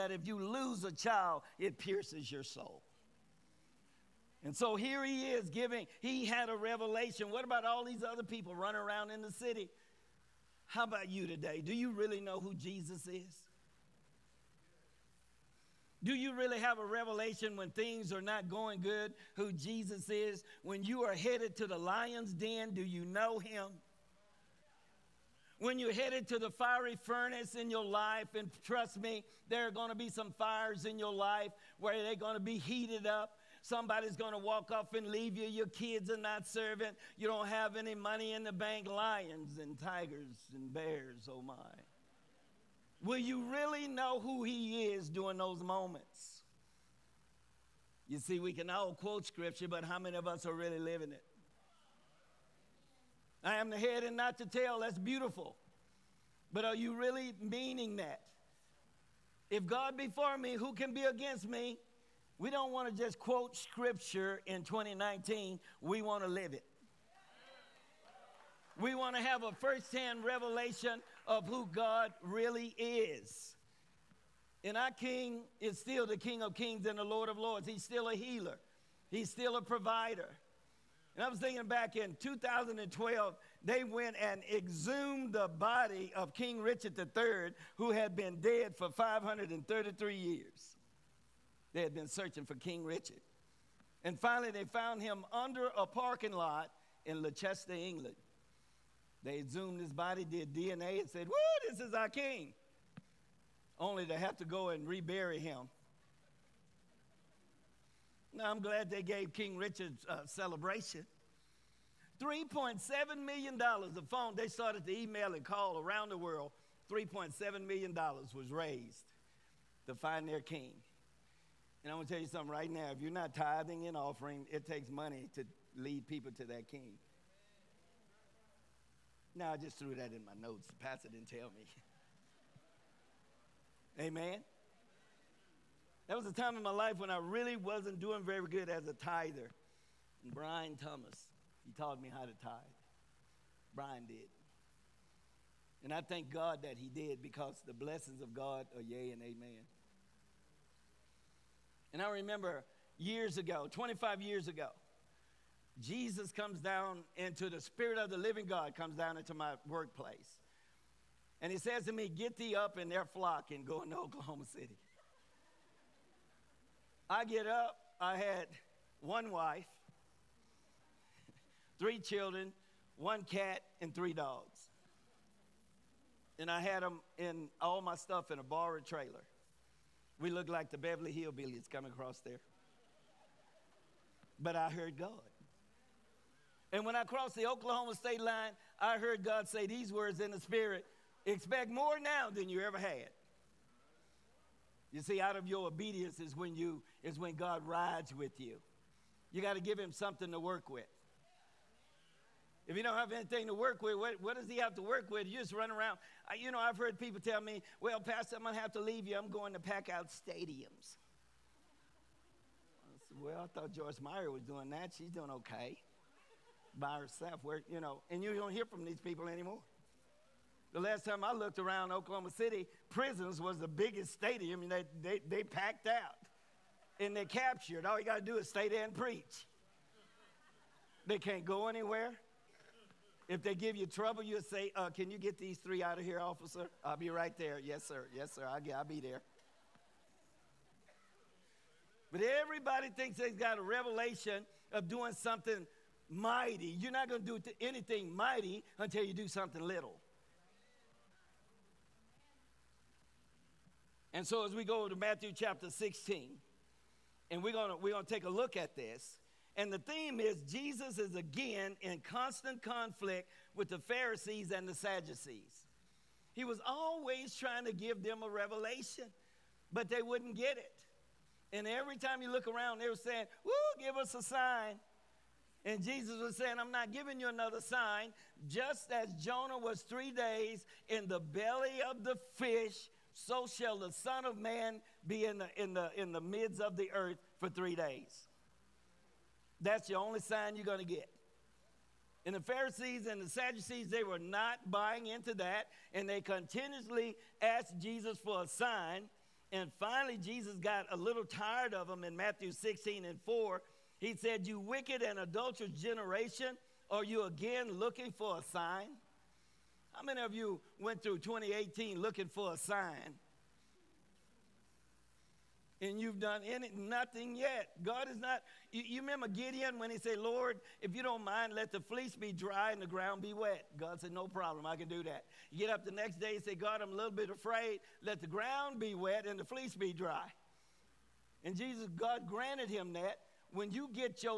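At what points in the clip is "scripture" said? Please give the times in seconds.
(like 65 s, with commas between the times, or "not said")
49 s, 63 s.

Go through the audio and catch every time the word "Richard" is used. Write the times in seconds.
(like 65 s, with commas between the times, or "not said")
86 s, 92 s, 109 s.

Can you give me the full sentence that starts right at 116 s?
$3.7 million was raised to find their king.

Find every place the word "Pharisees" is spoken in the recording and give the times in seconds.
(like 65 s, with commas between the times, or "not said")
263 s, 292 s.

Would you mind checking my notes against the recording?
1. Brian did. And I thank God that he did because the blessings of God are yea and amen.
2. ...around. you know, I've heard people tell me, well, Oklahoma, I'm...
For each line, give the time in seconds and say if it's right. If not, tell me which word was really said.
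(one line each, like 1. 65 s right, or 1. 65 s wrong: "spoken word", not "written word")
1. 143 s right
2. 205 s wrong: "Pastor", not "Oklahoma".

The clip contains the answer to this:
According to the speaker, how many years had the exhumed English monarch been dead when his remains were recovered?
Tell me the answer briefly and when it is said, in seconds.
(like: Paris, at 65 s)
533, at 88 s.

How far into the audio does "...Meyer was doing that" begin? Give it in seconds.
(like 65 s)
214 s.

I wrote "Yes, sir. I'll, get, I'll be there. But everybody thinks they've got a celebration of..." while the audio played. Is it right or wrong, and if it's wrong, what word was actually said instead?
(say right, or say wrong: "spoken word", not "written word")
wrong: "revelation", not "celebration".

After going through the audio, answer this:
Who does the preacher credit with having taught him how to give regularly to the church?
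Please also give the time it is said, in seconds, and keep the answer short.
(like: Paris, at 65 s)
Brian Thomas, at 140 s.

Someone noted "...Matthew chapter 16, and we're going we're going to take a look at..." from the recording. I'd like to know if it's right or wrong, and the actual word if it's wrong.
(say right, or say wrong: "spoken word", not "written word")
right.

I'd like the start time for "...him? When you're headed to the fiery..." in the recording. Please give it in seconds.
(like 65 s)
23 s.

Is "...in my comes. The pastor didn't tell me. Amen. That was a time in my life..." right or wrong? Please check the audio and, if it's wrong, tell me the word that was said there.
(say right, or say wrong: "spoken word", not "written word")
wrong: "notes", not "comes".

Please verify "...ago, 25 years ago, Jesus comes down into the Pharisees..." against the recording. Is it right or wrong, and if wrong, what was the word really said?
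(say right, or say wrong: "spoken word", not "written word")
wrong: "Spirit", not "Pharisees".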